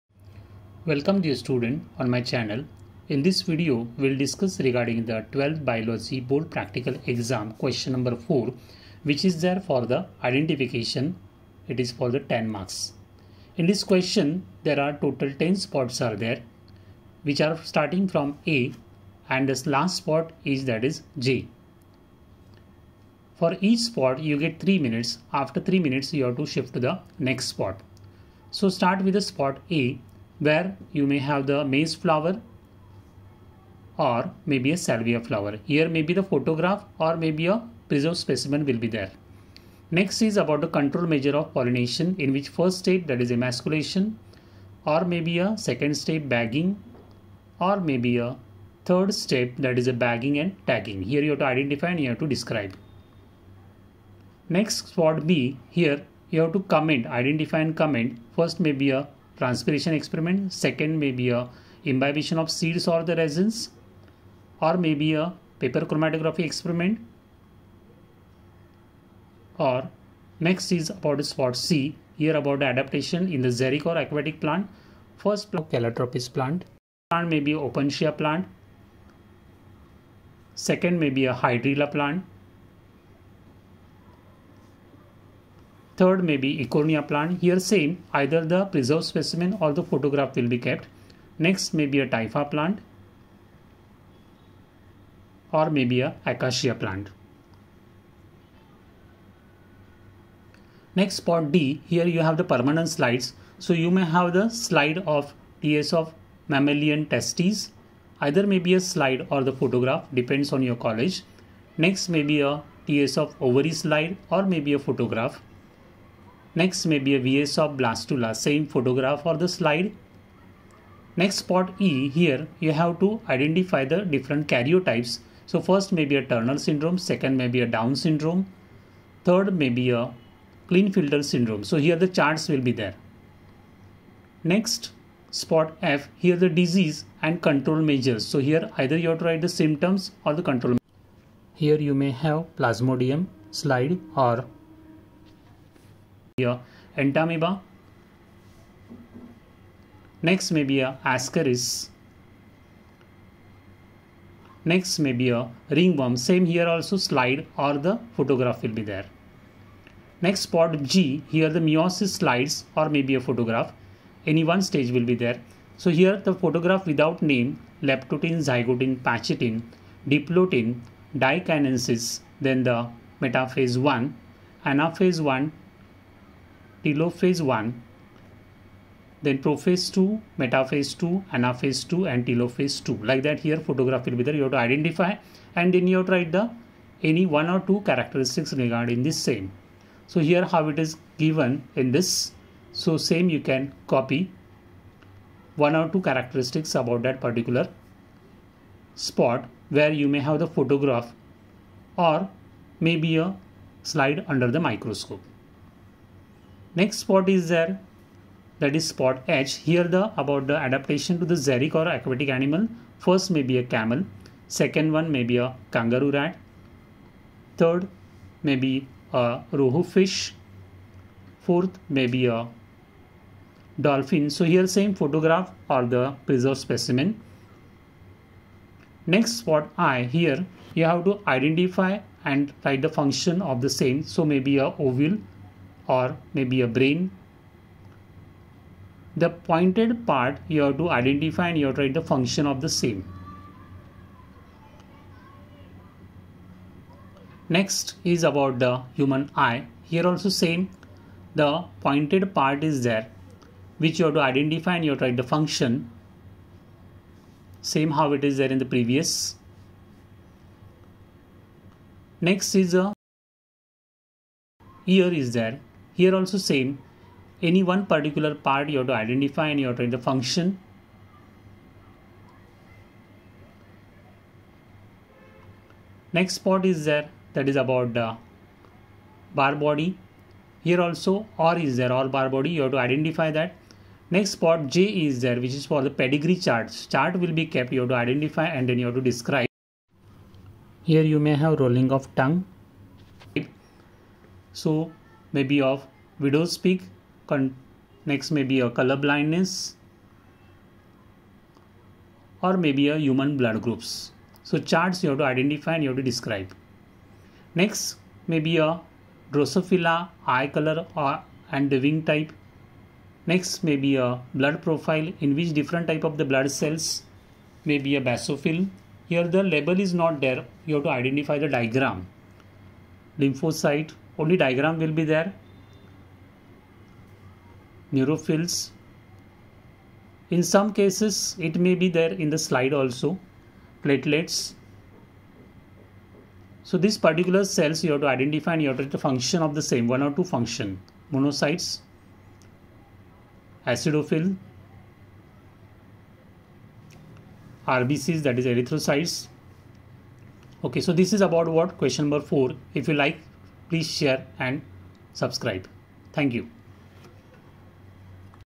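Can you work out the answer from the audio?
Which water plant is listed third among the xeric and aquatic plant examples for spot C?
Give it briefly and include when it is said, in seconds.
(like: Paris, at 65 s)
Eichhornia, at 86 s.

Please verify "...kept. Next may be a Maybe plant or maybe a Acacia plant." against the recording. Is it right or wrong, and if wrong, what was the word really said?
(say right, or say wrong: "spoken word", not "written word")
wrong: "Typha", not "Maybe".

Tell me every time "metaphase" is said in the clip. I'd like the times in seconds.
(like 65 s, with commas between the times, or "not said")
173 s, 180 s.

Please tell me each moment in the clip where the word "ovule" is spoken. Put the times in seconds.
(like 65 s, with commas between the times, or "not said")
234 s.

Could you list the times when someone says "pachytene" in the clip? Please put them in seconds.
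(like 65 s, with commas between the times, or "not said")
169 s.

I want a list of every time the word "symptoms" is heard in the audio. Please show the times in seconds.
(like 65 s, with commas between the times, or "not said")
139 s.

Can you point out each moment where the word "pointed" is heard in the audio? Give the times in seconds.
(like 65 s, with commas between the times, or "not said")
239 s, 251 s.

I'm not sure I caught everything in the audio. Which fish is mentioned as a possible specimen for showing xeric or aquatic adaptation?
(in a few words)
rohu fish.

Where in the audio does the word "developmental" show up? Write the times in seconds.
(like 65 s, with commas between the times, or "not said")
not said.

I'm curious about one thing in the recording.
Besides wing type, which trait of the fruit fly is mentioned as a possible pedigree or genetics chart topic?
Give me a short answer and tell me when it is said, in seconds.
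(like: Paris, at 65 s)
eye color, at 310 s.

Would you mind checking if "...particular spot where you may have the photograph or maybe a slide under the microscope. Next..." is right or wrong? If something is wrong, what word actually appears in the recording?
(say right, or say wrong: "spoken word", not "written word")
right.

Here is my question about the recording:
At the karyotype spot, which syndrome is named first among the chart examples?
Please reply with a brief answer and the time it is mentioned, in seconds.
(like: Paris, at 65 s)
Turner syndrome, at 126 s.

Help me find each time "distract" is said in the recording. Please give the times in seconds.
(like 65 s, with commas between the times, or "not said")
not said.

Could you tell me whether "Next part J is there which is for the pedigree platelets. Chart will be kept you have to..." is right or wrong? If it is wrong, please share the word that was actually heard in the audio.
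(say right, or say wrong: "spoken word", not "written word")
wrong: "charts", not "platelets".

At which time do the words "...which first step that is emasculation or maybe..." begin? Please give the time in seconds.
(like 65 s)
42 s.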